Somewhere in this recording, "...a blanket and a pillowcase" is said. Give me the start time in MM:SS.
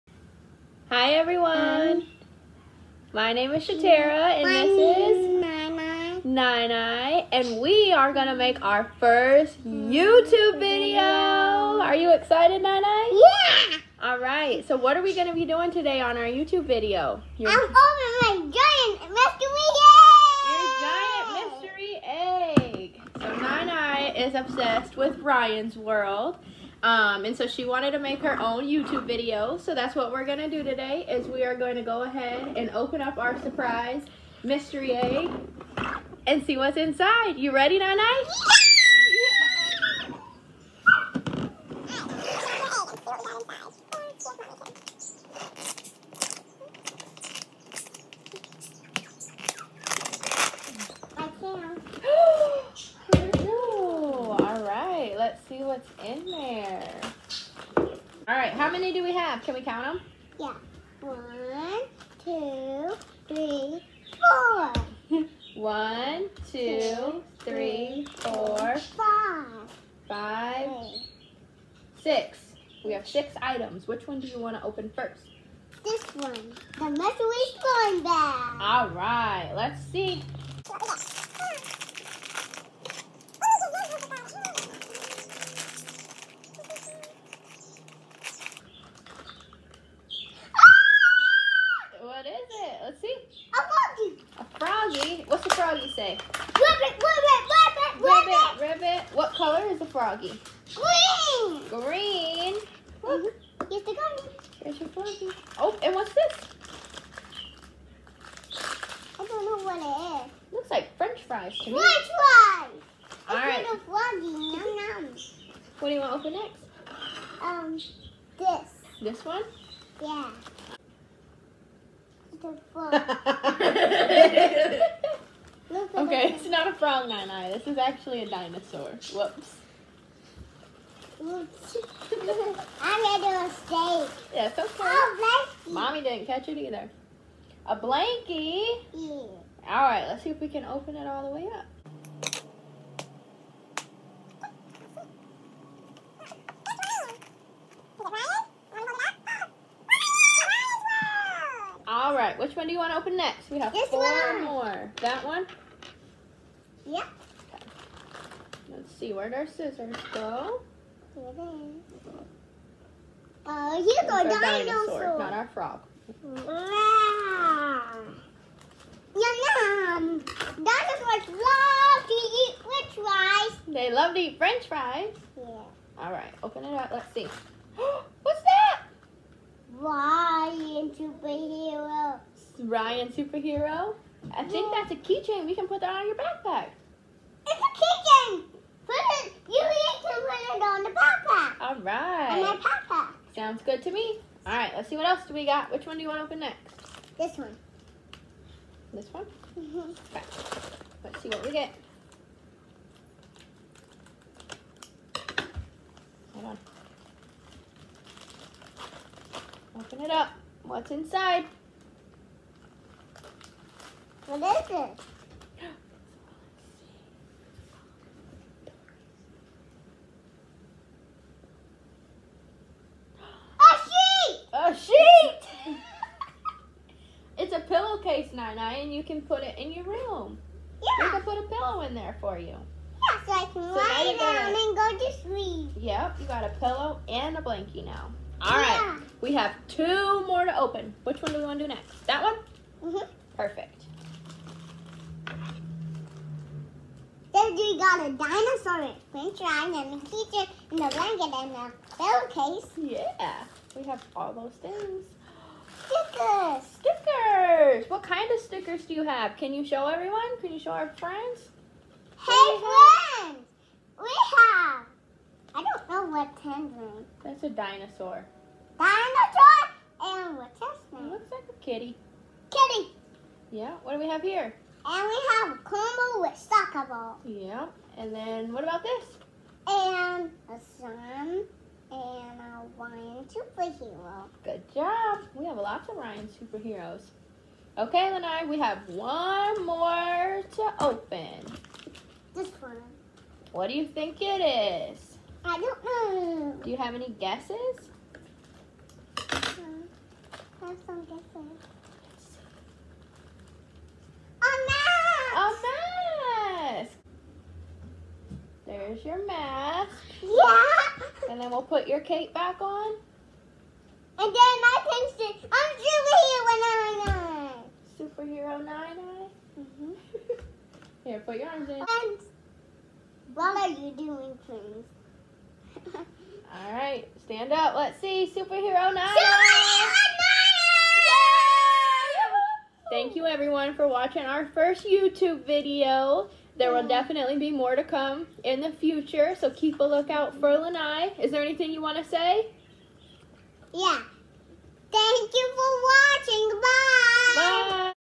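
04:10.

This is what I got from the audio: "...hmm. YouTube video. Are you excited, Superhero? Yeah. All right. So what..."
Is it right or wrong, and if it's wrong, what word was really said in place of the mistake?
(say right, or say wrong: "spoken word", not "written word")
wrong: "Nai", not "Superhero".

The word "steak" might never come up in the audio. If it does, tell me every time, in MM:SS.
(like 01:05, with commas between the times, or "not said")
02:11.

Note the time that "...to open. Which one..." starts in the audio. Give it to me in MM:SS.
04:00.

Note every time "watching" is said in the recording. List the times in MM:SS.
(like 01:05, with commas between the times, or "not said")
05:33, 05:46.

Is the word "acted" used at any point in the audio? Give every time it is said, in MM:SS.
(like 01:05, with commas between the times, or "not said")
not said.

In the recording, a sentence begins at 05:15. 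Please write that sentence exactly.
I'm Superhero 9 Superhero 9 mm -hmm.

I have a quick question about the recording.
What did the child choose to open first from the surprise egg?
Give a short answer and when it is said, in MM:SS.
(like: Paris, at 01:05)
the mystery slime bag, at 01:16.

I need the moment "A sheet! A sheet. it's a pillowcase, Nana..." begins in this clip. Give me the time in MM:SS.
03:43.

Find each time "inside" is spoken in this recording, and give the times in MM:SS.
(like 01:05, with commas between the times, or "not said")
00:36, 03:30.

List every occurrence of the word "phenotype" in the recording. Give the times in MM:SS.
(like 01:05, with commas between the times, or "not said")
not said.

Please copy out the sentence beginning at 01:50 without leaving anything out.
Looks like french fries to me.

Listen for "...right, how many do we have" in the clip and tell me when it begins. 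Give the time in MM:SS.
00:58.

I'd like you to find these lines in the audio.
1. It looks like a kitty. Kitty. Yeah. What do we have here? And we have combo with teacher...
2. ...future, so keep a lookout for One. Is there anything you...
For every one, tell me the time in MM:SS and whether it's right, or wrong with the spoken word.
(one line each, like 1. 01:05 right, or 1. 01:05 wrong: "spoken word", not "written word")
1. 04:31 wrong: "soccer", not "teacher"
2. 05:38 wrong: "Lynnai", not "One".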